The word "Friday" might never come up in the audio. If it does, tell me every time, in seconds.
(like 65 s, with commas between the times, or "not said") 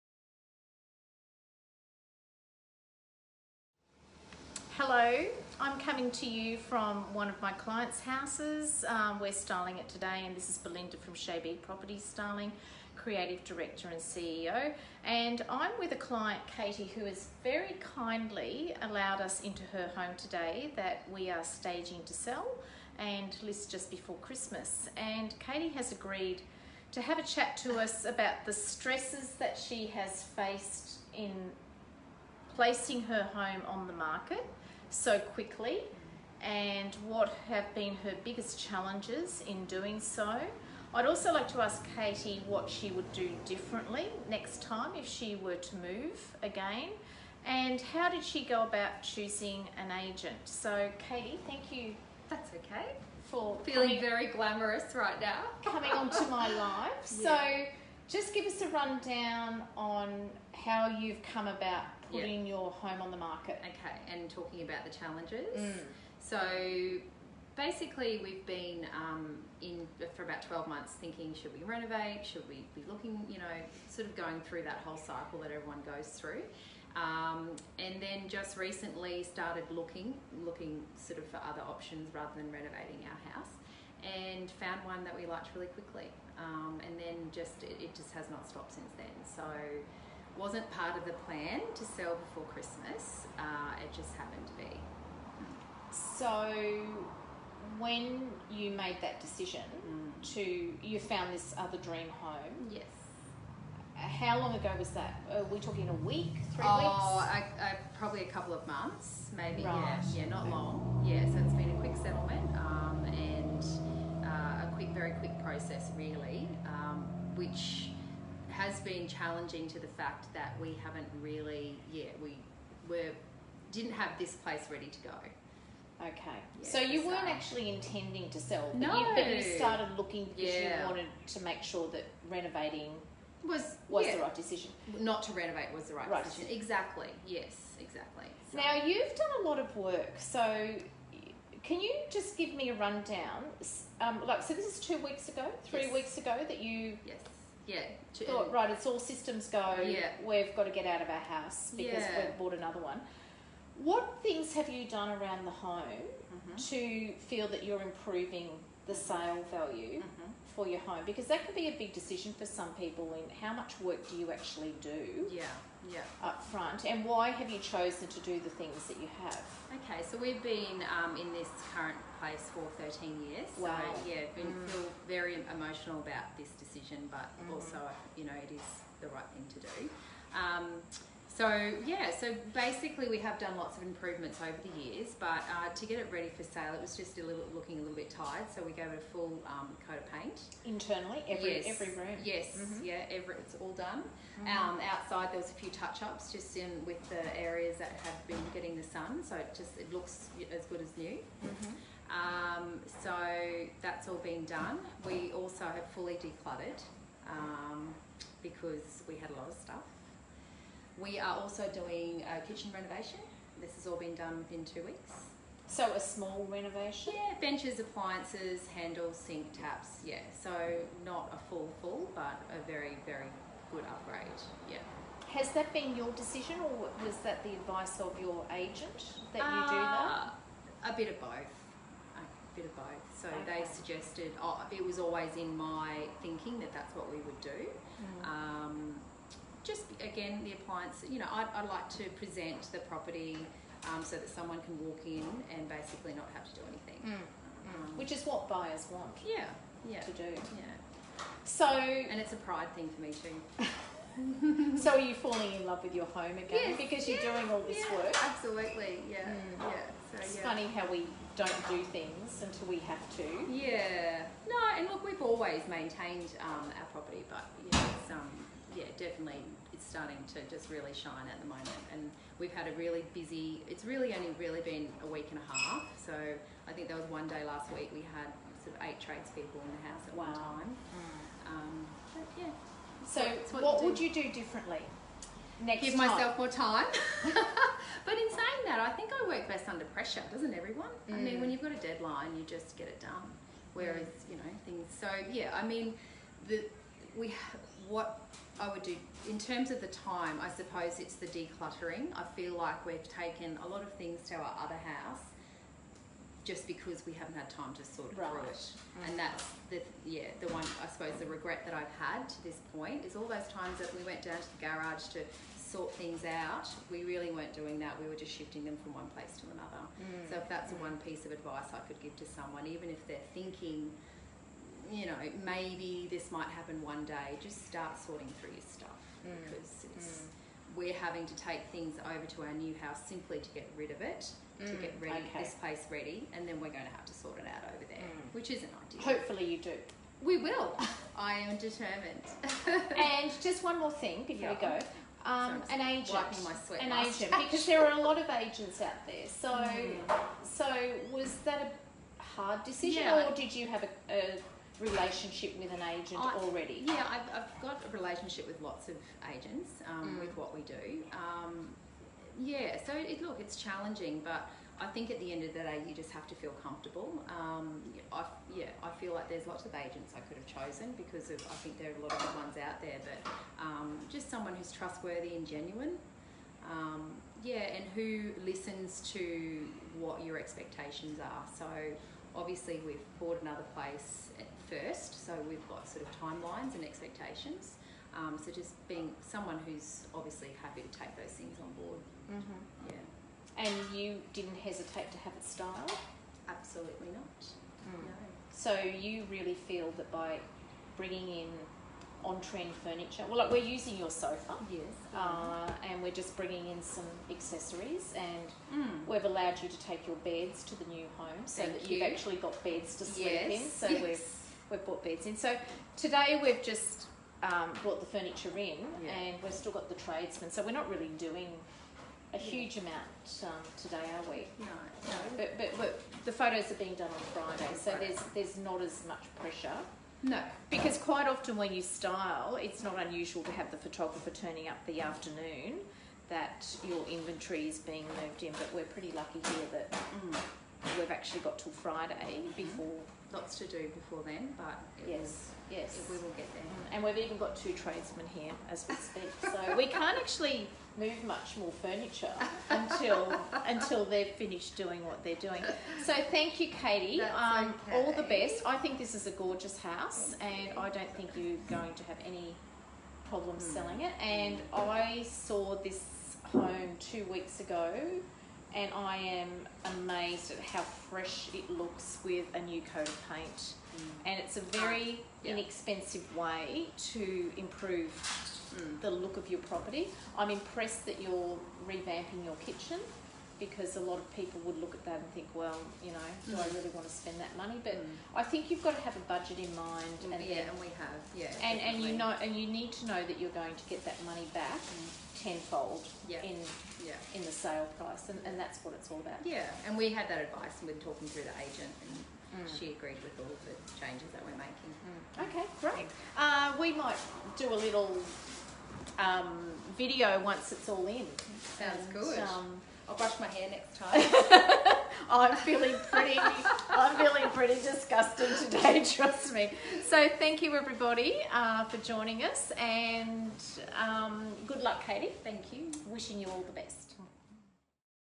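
427 s, 441 s.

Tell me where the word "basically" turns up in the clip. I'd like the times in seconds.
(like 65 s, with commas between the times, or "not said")
67 s, 182 s, 245 s.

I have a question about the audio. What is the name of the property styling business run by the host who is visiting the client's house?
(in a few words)
Chez B Property Styling.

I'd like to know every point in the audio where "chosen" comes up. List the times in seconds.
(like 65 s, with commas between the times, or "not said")
167 s, 370 s.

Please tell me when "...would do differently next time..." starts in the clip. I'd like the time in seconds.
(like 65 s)
42 s.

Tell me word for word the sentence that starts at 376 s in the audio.
Um, yeah, and who listens to what your expectations are.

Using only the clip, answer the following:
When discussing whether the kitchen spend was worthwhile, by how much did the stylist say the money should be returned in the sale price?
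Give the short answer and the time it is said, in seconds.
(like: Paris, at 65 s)
Tenfold, at 495 s.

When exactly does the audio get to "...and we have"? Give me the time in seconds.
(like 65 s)
490 s.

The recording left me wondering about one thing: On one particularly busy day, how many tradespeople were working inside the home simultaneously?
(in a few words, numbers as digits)
8.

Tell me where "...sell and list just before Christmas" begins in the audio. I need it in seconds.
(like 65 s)
22 s.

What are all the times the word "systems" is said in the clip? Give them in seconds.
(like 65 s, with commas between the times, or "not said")
148 s.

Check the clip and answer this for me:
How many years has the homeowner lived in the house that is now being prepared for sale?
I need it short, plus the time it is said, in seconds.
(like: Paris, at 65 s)
13, at 172 s.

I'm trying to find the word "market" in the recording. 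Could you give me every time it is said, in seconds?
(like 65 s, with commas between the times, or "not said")
33 s, 63 s.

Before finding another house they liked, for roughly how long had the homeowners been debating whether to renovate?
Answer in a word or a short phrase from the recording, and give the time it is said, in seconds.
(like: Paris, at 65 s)
12 months, at 70 s.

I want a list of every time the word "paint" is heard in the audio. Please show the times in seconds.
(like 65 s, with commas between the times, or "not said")
190 s, 473 s.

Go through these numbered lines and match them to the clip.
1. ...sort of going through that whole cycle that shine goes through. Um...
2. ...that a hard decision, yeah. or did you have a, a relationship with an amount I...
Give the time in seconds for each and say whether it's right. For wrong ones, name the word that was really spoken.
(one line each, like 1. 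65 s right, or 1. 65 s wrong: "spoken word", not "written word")
1. 73 s wrong: "everyone", not "shine"
2. 351 s wrong: "agent", not "amount".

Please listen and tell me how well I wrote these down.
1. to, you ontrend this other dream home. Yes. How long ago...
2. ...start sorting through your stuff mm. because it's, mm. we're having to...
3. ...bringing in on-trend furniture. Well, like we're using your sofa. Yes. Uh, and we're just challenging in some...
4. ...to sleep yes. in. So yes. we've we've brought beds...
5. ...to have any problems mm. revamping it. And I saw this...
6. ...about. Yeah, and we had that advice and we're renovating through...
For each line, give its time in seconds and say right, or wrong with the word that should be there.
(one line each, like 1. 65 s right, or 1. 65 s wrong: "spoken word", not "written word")
1. 100 s wrong: "found", not "ontrend"
2. 327 s right
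3. 400 s wrong: "bringing", not "challenging"
4. 412 s right
5. 461 s wrong: "selling", not "revamping"
6. 499 s wrong: "talking", not "renovating".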